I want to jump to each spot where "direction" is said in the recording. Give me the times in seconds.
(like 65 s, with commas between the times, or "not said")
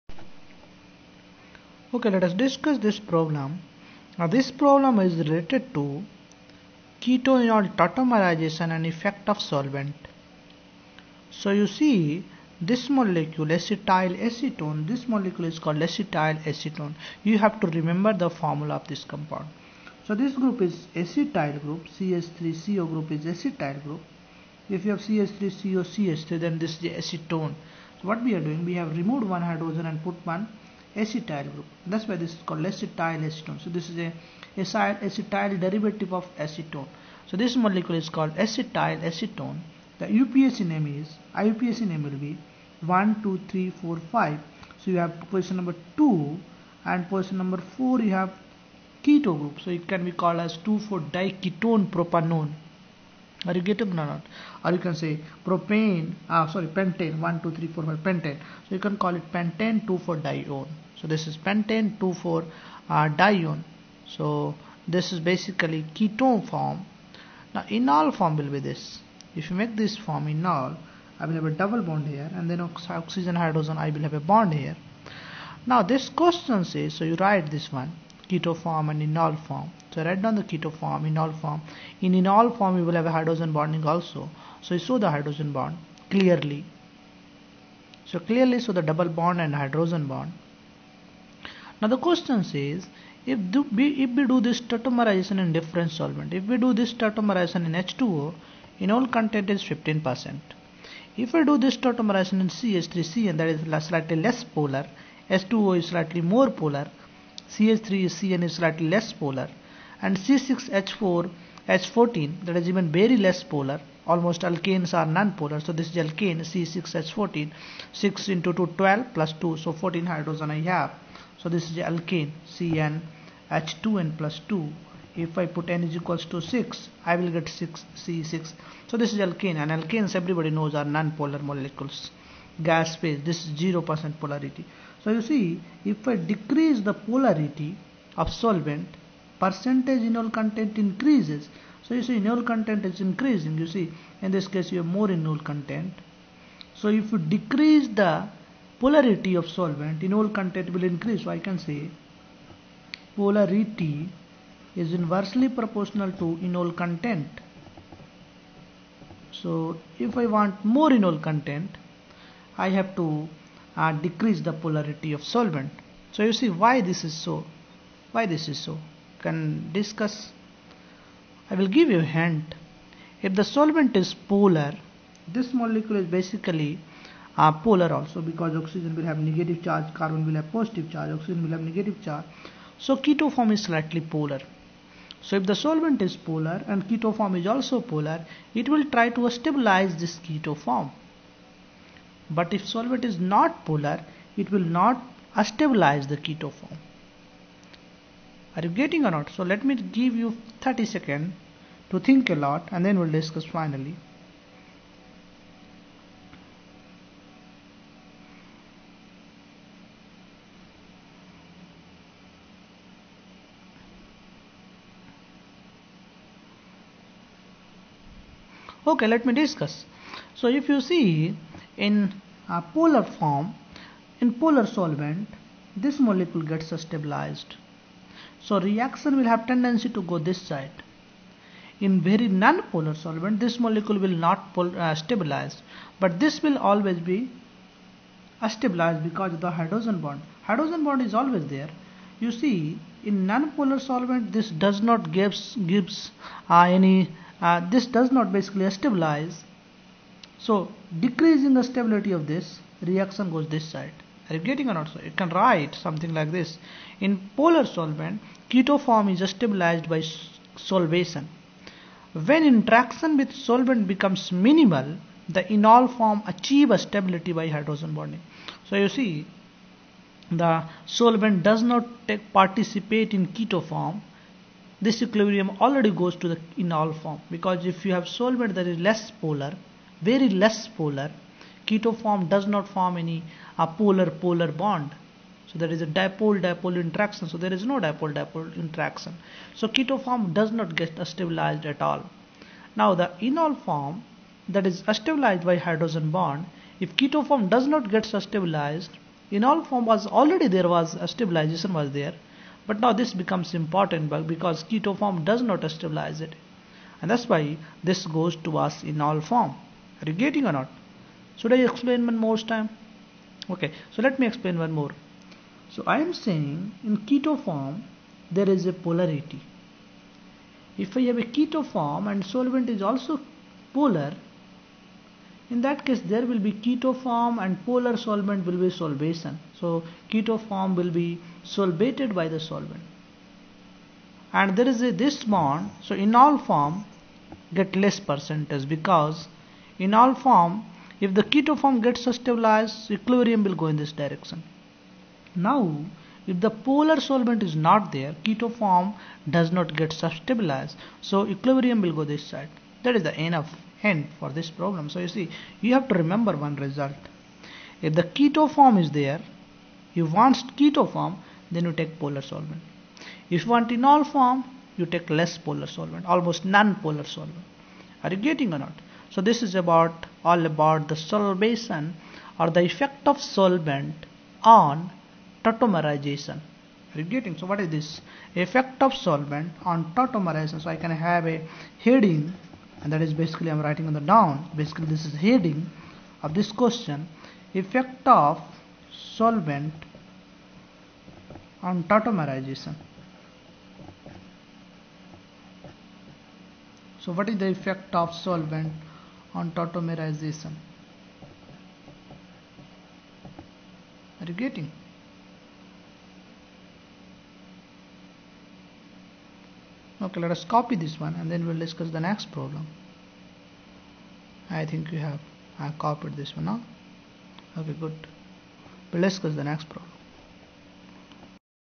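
344 s.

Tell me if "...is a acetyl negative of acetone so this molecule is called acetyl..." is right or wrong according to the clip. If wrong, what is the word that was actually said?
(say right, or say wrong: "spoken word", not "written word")
wrong: "derivative", not "negative".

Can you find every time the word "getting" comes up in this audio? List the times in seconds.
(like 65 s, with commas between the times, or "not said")
53 s, 198 s, 254 s, 310 s, 368 s, 377 s, 404 s.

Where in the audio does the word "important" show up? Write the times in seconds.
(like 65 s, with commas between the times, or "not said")
303 s.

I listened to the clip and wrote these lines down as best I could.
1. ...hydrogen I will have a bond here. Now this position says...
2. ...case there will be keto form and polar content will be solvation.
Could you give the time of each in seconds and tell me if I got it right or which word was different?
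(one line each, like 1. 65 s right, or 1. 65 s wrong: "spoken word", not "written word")
1. 73 s wrong: "question", not "position"
2. 325 s wrong: "solvent", not "content".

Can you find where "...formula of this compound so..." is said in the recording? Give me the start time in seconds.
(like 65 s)
18 s.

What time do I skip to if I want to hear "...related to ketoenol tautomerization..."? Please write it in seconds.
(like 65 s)
5 s.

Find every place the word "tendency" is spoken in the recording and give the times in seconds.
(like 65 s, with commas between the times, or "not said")
229 s.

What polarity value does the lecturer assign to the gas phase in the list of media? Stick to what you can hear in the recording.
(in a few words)
0%.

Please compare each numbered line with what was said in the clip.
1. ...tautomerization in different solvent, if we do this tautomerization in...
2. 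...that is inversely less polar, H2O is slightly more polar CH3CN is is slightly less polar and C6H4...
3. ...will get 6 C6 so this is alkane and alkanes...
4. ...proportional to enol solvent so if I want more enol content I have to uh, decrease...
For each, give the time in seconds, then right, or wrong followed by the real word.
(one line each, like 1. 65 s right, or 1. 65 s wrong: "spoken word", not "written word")
1. 94 s right
2. 103 s wrong: "slightly", not "inversely"
3. 127 s right
4. 155 s wrong: "content", not "solvent".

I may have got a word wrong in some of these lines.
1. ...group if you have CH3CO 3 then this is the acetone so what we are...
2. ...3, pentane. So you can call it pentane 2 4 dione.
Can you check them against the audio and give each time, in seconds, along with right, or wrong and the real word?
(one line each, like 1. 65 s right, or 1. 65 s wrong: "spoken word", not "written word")
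1. 23 s right
2. 57 s right.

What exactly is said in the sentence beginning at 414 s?
I think you have I copied this one now.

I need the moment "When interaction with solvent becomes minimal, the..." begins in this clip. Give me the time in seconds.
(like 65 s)
262 s.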